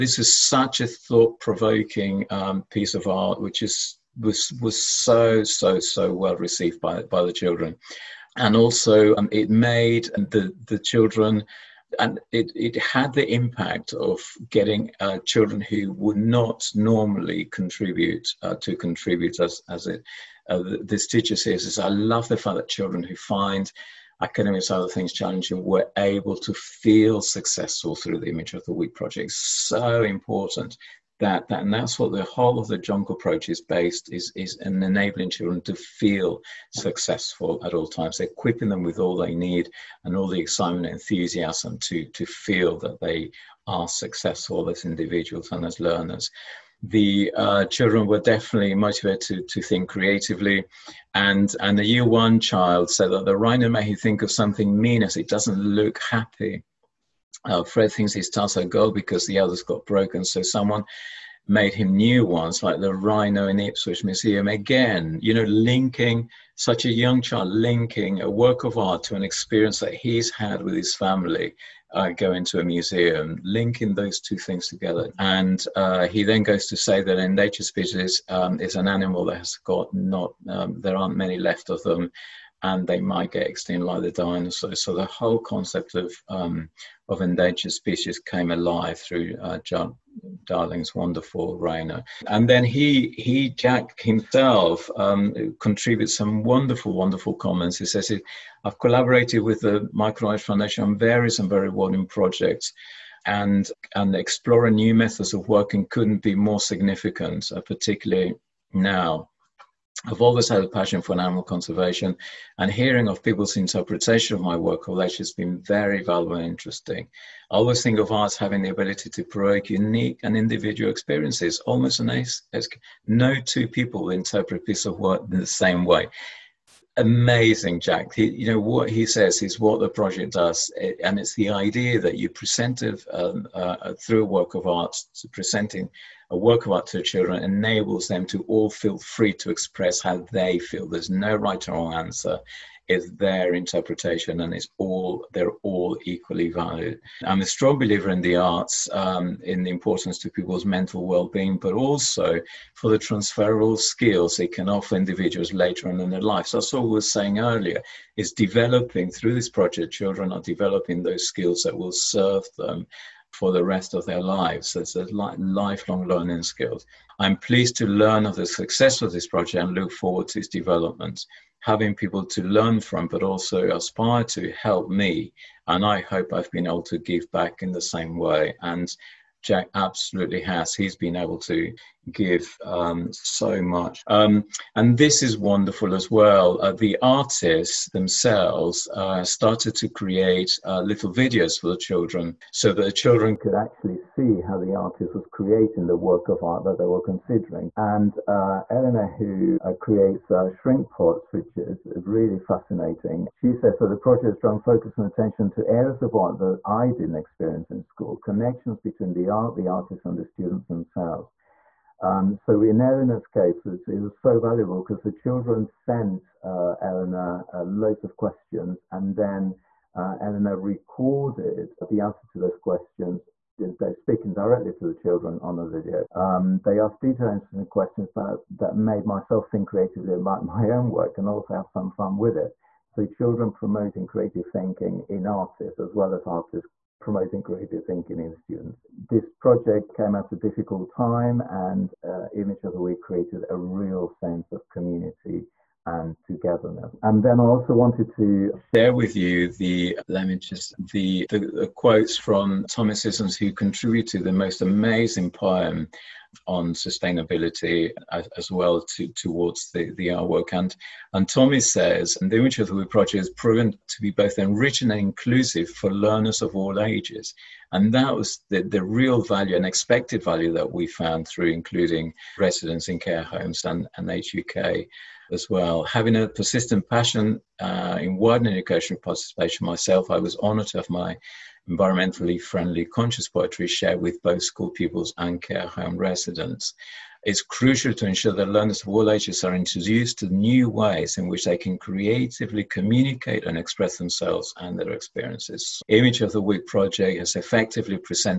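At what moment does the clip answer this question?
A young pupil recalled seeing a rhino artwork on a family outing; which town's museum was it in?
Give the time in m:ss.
1:03.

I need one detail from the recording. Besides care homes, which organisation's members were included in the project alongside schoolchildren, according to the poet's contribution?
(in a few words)
Age UK.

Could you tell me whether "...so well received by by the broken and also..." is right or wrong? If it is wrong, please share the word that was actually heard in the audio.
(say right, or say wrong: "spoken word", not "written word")
wrong: "children", not "broken".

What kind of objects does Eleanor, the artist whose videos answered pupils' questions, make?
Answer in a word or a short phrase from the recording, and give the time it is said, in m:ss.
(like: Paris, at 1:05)
Shrink pots, at 3:20.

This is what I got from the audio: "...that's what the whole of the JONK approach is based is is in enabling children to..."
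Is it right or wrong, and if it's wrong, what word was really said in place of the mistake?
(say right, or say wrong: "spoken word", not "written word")
right.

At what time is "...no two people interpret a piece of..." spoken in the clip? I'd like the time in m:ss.
2:03.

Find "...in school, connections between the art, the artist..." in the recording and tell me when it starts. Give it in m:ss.
3:27.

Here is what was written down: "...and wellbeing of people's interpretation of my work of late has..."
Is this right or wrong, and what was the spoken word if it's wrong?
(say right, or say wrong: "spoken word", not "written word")
wrong: "hearing", not "wellbeing".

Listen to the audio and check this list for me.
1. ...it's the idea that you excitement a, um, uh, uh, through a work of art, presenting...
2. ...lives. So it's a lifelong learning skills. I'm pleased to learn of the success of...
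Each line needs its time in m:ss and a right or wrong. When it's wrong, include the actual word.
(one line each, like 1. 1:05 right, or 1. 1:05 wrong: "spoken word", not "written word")
1. 2:11 wrong: "present", not "excitement"
2. 2:44 right.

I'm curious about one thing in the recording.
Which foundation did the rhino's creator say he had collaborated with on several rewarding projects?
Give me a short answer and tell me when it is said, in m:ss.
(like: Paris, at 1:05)
Michael Aldrich Foundation, at 1:39.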